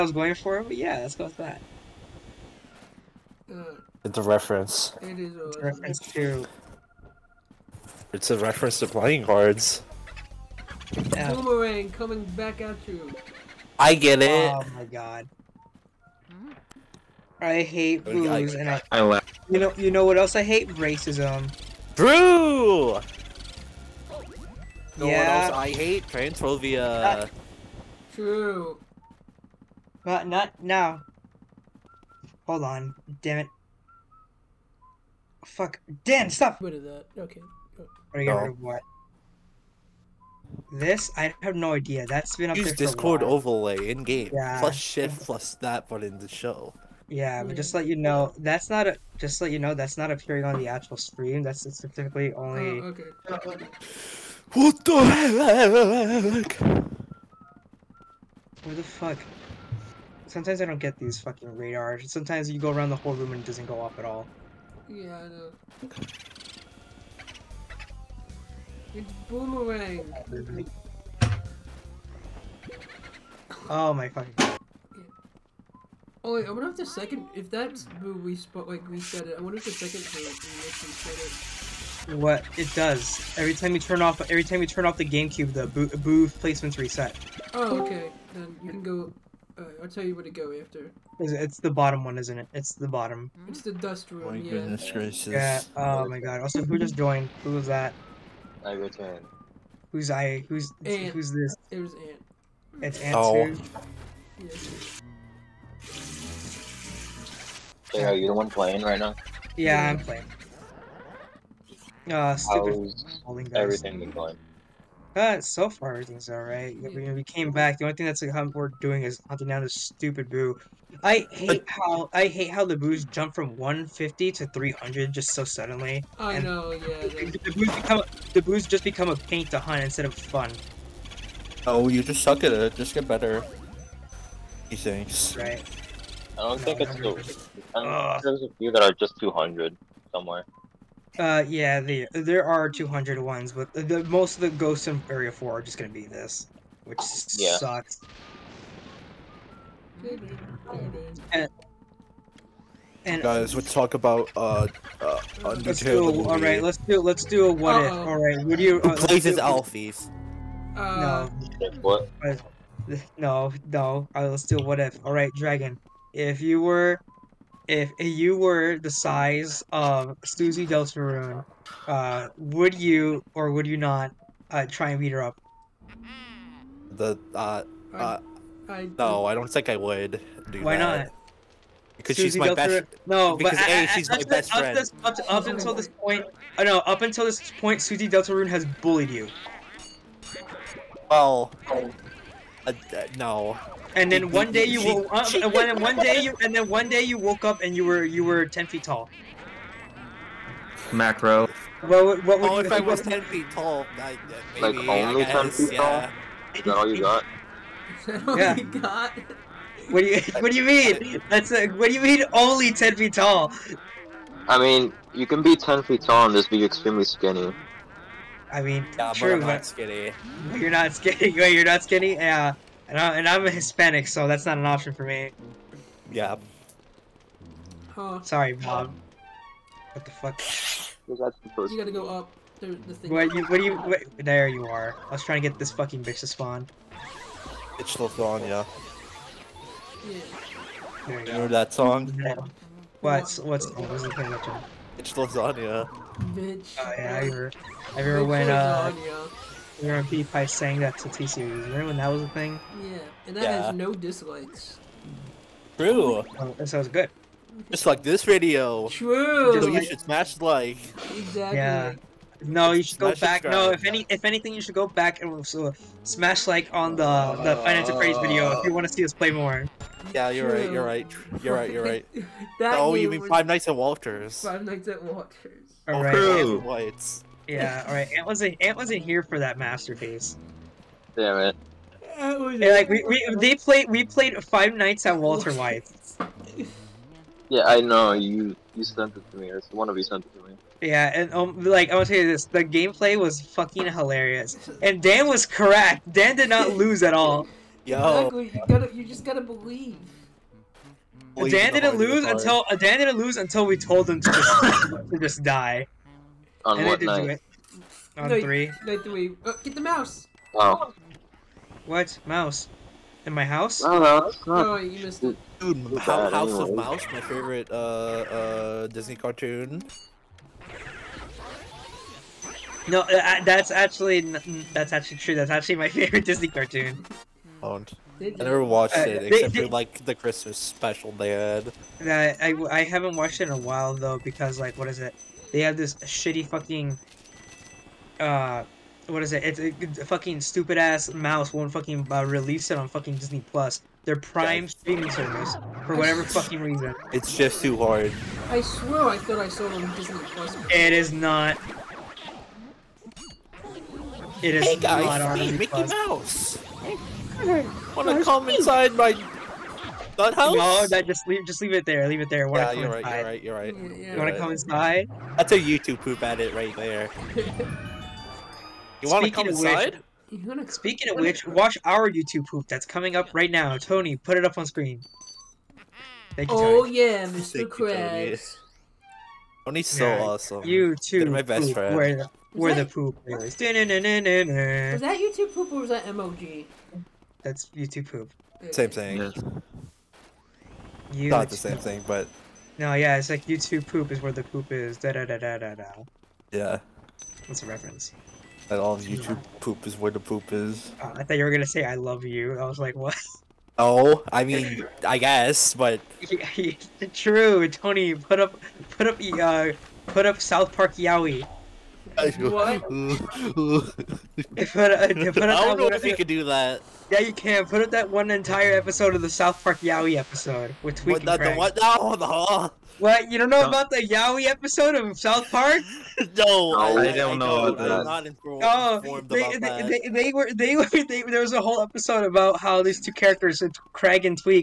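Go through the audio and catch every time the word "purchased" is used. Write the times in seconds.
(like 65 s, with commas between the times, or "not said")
not said.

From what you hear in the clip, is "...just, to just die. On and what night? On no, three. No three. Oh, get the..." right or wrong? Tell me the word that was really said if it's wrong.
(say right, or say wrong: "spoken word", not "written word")
right.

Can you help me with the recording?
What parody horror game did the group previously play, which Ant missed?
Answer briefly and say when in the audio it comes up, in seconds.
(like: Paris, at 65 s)
Five Nights at Walter White, at 284 s.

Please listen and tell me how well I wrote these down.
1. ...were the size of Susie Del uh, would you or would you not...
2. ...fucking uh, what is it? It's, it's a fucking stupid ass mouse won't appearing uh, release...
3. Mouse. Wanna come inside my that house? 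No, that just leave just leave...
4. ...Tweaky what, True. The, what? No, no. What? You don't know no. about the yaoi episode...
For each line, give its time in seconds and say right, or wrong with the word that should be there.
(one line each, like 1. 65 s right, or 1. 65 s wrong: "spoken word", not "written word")
1. 168 s right
2. 336 s wrong: "fucking", not "appearing"
3. 356 s right
4. 421 s wrong: "Craig", not "True".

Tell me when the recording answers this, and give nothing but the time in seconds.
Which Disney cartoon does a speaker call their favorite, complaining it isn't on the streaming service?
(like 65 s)
315 s.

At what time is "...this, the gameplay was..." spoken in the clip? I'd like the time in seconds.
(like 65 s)
292 s.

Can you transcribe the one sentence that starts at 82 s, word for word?
What it does every time you turn off every time you turn off the GameCube, the boo, boo placements reset.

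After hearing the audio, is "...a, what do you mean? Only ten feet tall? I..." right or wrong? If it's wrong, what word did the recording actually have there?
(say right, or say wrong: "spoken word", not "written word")
right.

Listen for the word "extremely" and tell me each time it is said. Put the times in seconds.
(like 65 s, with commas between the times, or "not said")
216 s.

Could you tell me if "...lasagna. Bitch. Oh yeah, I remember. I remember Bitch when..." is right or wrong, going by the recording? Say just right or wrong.
right.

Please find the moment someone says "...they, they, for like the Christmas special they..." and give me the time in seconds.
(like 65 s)
329 s.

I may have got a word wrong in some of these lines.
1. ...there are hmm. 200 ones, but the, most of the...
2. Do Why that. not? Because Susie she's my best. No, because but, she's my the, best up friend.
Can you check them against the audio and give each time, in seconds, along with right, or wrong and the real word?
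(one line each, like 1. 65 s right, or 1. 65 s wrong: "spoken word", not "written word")
1. 142 s right
2. 180 s right.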